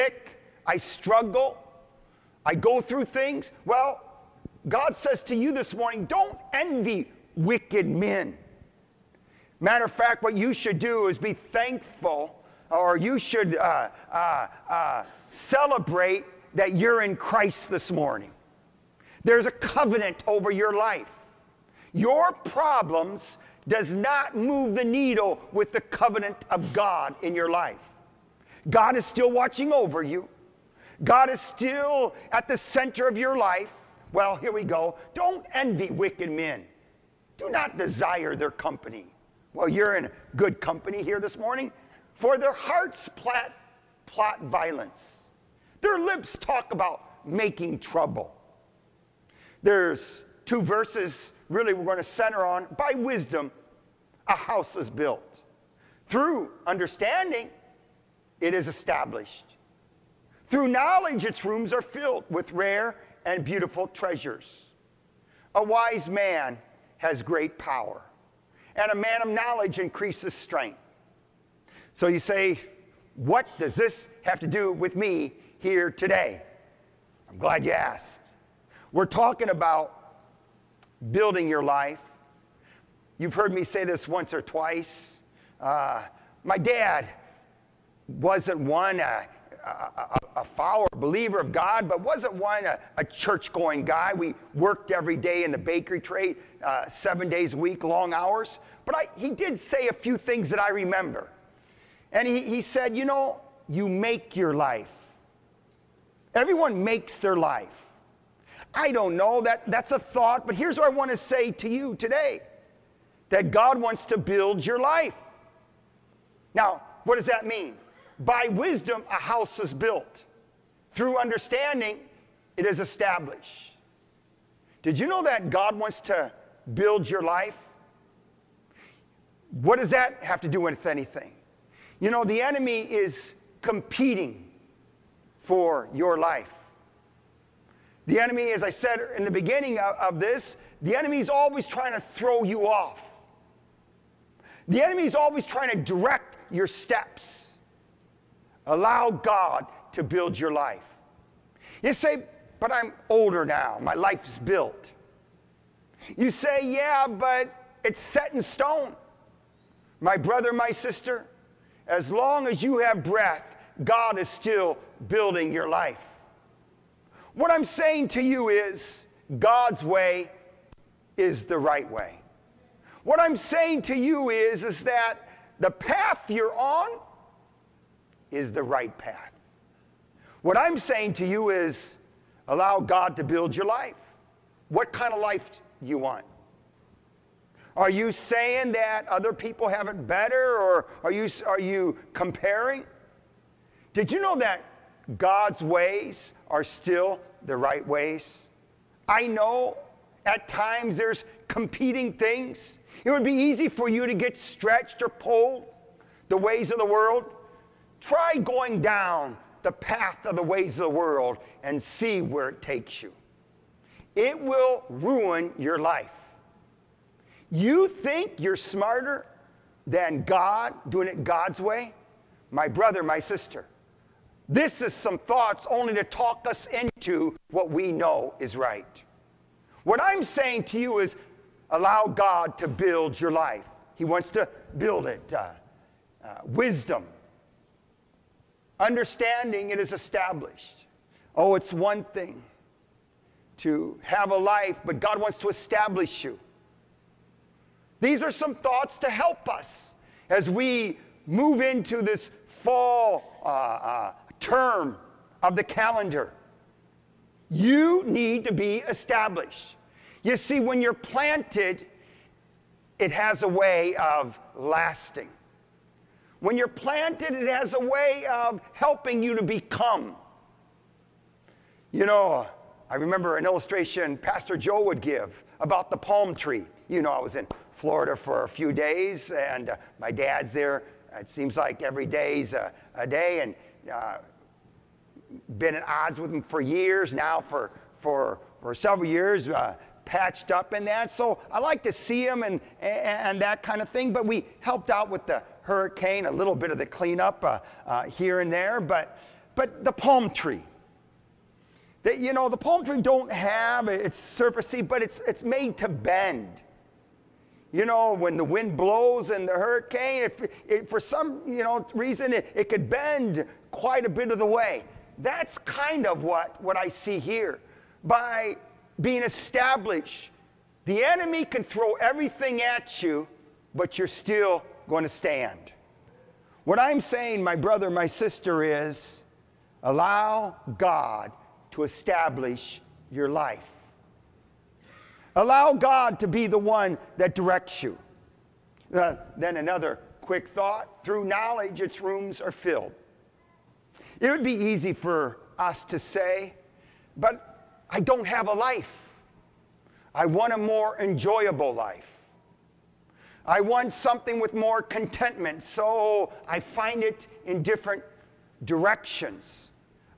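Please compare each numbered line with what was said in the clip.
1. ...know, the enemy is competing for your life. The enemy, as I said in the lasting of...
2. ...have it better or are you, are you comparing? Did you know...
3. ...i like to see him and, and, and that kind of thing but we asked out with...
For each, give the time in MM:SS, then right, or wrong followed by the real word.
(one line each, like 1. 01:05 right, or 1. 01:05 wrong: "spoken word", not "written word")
1. 02:12 wrong: "beginning", not "lasting"
2. 03:09 right
3. 04:51 wrong: "helped", not "asked".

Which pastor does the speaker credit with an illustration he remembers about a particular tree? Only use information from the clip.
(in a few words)
Pastor Joe.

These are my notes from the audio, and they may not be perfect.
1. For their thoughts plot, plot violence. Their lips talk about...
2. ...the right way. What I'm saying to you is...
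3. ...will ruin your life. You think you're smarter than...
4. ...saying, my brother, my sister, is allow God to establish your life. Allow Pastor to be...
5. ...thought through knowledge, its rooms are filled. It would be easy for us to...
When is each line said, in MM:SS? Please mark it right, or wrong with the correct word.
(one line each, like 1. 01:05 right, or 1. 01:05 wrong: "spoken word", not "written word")
1. 00:42 wrong: "hearts", not "thoughts"
2. 02:51 right
3. 03:34 right
4. 05:26 wrong: "God", not "Pastor"
5. 05:40 right.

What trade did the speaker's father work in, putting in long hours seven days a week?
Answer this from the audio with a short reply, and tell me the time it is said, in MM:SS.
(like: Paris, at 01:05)
bakery trade, at 01:35.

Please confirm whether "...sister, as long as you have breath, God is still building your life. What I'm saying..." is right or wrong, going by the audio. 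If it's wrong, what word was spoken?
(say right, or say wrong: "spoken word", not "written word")
right.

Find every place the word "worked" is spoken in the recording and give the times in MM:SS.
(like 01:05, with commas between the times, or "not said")
01:34.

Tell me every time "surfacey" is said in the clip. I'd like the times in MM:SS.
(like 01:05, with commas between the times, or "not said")
05:04.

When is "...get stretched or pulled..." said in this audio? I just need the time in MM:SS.
03:24.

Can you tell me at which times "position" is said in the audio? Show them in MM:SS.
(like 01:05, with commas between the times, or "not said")
not said.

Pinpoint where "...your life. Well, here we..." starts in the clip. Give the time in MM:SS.
00:33.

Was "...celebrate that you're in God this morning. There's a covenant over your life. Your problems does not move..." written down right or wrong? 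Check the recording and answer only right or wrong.
wrong.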